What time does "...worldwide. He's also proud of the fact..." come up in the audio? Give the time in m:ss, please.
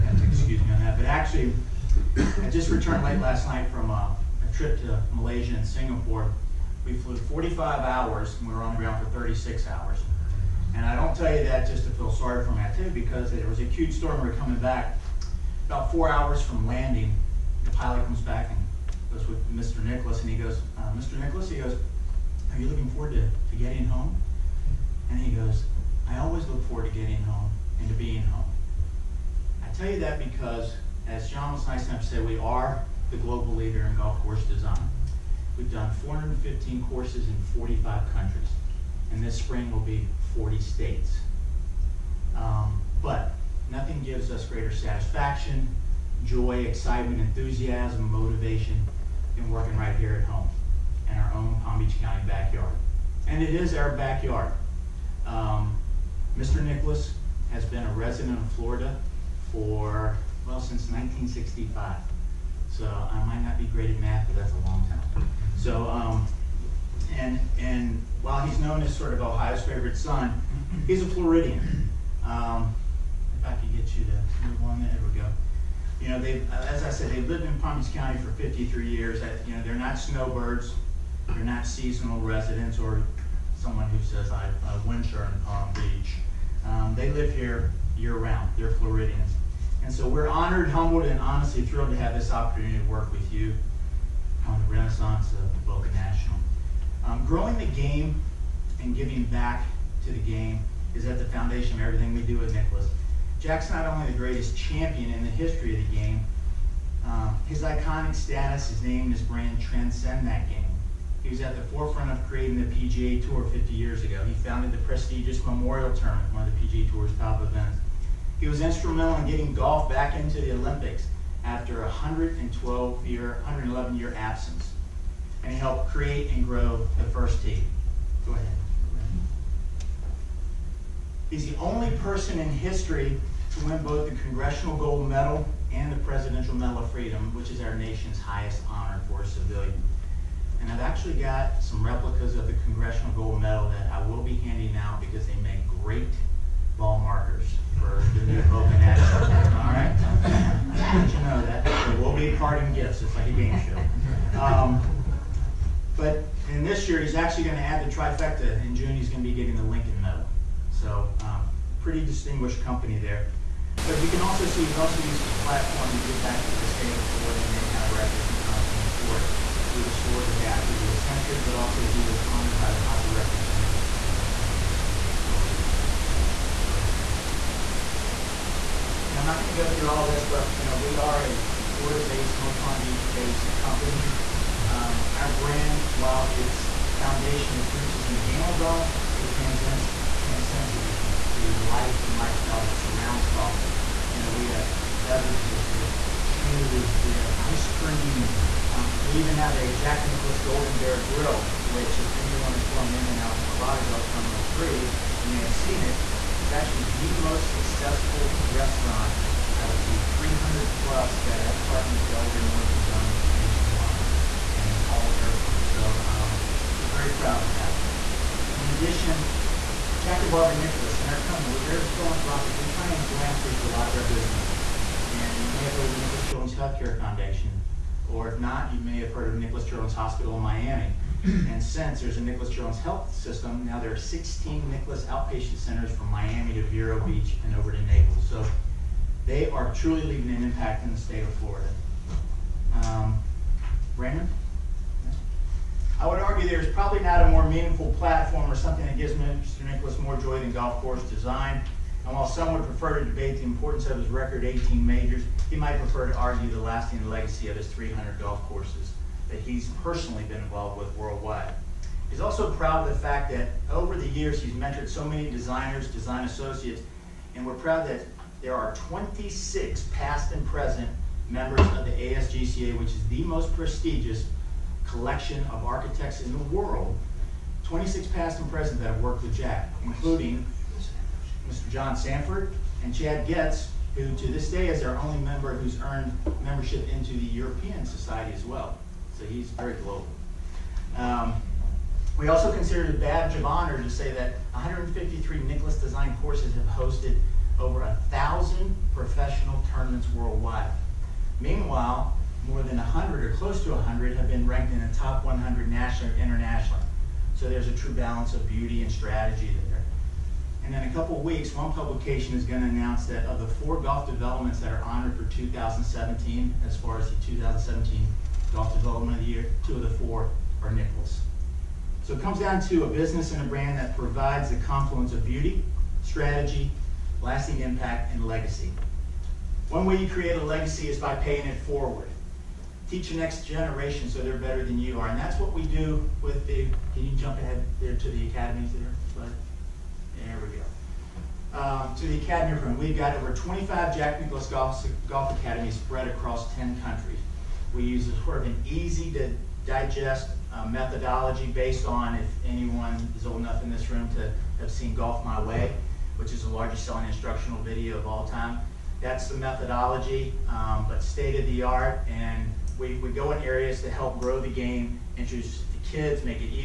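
4:20.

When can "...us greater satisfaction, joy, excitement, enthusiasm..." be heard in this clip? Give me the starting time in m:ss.
0:44.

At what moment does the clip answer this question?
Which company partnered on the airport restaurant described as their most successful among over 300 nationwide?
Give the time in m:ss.
3:32.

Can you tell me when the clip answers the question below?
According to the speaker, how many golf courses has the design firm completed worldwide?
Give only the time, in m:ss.
0:36.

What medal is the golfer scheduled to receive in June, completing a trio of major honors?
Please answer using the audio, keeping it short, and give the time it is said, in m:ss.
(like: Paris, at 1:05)
Lincoln Medal, at 2:39.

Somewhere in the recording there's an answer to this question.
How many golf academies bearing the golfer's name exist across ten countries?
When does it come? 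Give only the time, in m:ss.
5:43.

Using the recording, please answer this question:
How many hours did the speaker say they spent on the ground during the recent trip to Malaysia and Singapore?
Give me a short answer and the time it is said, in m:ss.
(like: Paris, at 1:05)
36, at 0:09.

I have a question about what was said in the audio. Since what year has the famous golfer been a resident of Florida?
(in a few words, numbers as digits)
1965.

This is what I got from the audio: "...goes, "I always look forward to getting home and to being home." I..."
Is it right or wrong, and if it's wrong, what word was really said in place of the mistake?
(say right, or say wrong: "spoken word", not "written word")
right.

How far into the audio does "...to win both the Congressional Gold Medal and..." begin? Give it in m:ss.
2:13.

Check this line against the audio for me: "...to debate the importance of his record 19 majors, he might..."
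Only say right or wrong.
wrong.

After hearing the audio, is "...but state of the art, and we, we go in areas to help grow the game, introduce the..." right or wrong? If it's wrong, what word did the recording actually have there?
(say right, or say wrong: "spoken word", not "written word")
right.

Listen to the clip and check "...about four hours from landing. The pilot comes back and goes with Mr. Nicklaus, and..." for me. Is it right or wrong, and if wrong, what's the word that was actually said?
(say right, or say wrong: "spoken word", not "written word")
right.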